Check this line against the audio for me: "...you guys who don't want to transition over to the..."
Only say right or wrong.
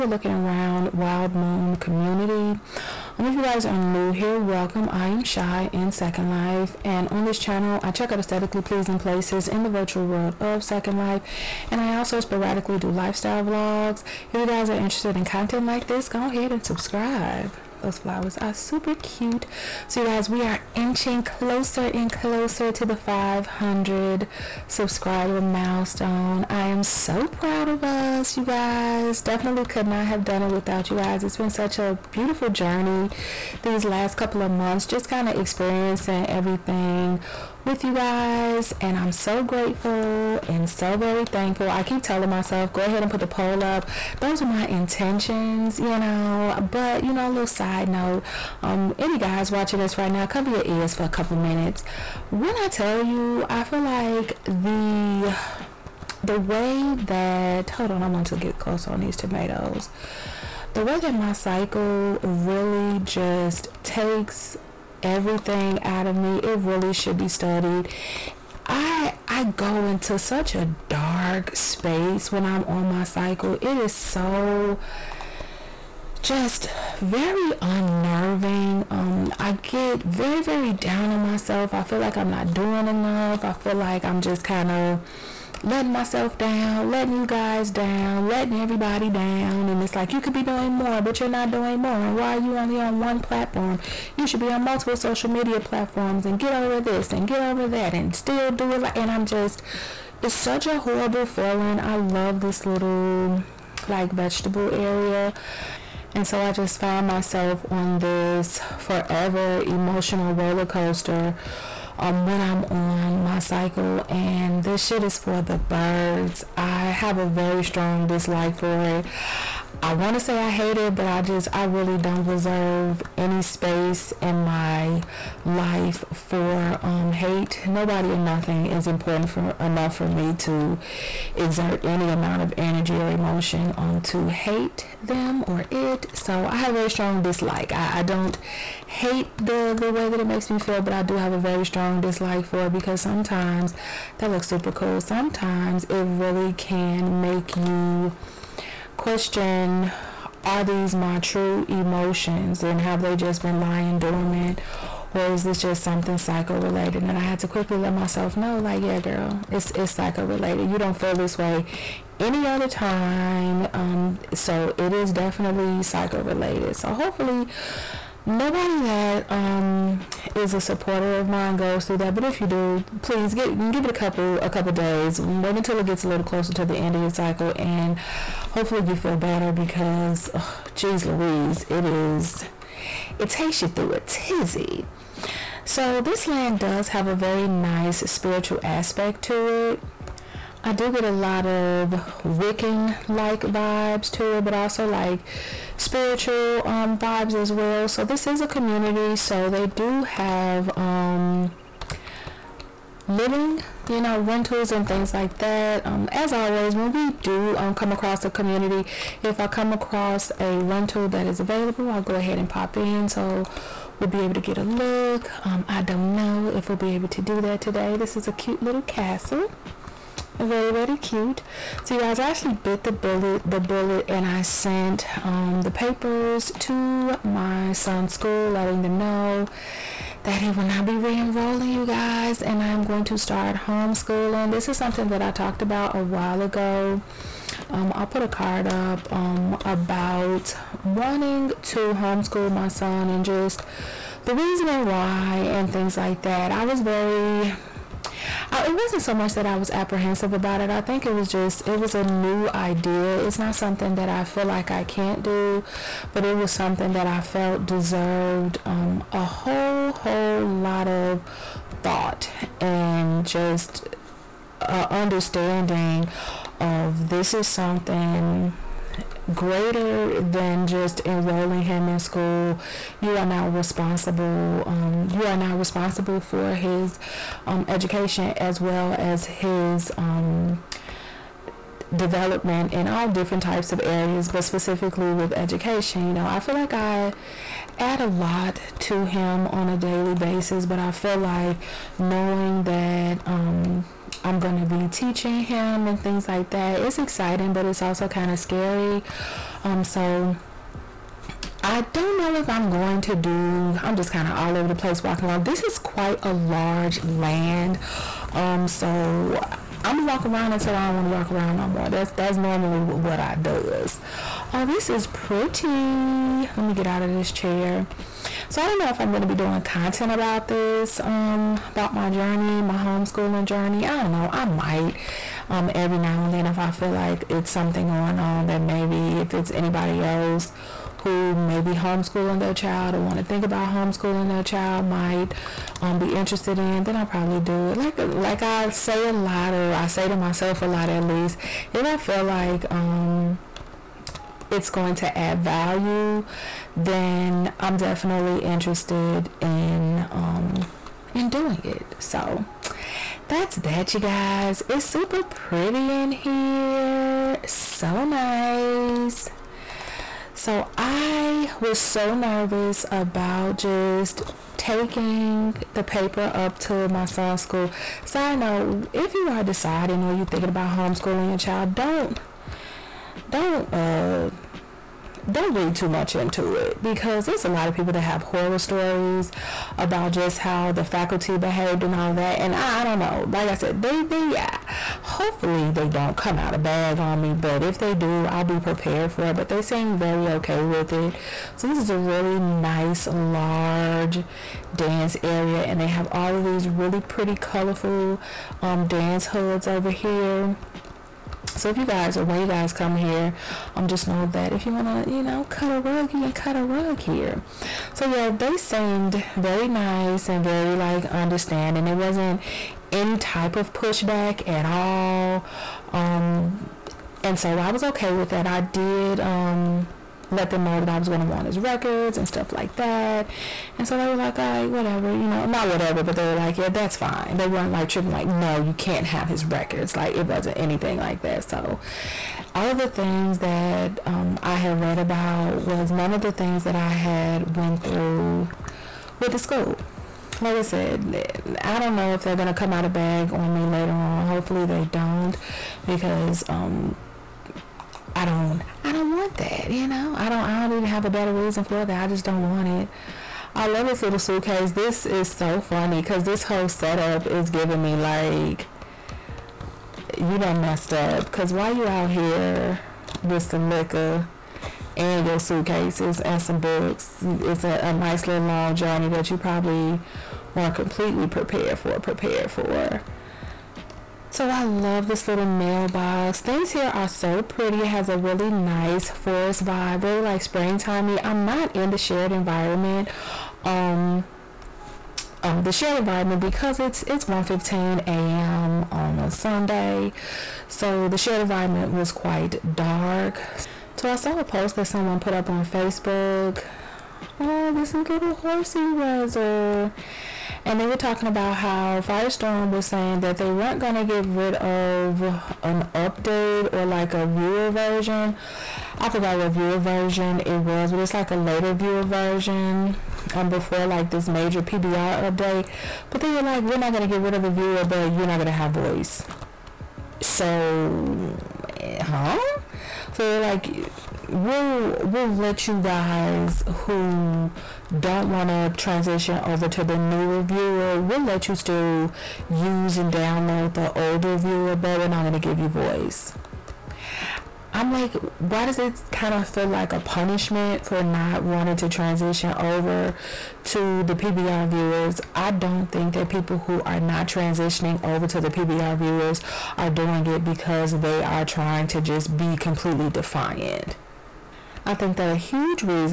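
right.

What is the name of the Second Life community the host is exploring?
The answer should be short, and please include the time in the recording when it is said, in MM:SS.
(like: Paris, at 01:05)
Wild Moon, at 00:00.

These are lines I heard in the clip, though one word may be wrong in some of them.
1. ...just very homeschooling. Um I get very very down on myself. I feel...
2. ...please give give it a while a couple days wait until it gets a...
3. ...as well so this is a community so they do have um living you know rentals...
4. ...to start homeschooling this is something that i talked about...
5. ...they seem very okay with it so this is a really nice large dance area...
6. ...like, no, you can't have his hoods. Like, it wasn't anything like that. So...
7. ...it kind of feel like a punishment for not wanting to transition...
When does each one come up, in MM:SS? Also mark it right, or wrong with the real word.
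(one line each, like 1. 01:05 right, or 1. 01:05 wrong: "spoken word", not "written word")
1. 01:16 wrong: "unnerving", not "homeschooling"
2. 02:53 wrong: "couple", not "while"
3. 03:17 right
4. 03:53 right
5. 06:29 right
6. 07:08 wrong: "records", not "hoods"
7. 08:58 right.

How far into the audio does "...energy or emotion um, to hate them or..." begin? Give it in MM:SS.
02:12.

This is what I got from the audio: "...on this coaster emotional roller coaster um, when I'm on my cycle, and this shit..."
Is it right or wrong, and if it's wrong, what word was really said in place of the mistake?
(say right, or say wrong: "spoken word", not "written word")
wrong: "forever", not "coaster".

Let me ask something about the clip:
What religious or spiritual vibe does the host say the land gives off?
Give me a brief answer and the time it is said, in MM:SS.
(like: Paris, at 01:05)
Wiccan, at 03:12.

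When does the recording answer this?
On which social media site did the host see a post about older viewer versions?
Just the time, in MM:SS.
08:15.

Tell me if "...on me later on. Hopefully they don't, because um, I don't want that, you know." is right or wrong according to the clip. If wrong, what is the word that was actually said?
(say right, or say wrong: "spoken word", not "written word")
right.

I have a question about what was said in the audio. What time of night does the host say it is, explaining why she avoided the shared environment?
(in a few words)
1:15 a.m.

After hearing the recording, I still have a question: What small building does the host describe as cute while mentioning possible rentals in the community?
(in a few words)
castle.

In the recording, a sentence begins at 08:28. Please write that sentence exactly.
I forgot what viewer version it was, but it's like a later viewer version um, before like this major PBR update.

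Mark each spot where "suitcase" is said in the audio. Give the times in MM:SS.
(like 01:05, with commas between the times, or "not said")
07:34, 07:45.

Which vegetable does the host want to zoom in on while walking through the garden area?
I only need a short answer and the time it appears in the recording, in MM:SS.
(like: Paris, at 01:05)
tomatoes, at 00:59.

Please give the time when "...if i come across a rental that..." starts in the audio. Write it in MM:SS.
03:29.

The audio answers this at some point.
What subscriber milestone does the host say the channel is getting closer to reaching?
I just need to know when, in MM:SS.
00:22.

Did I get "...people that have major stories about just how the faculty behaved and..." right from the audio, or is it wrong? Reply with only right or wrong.
wrong.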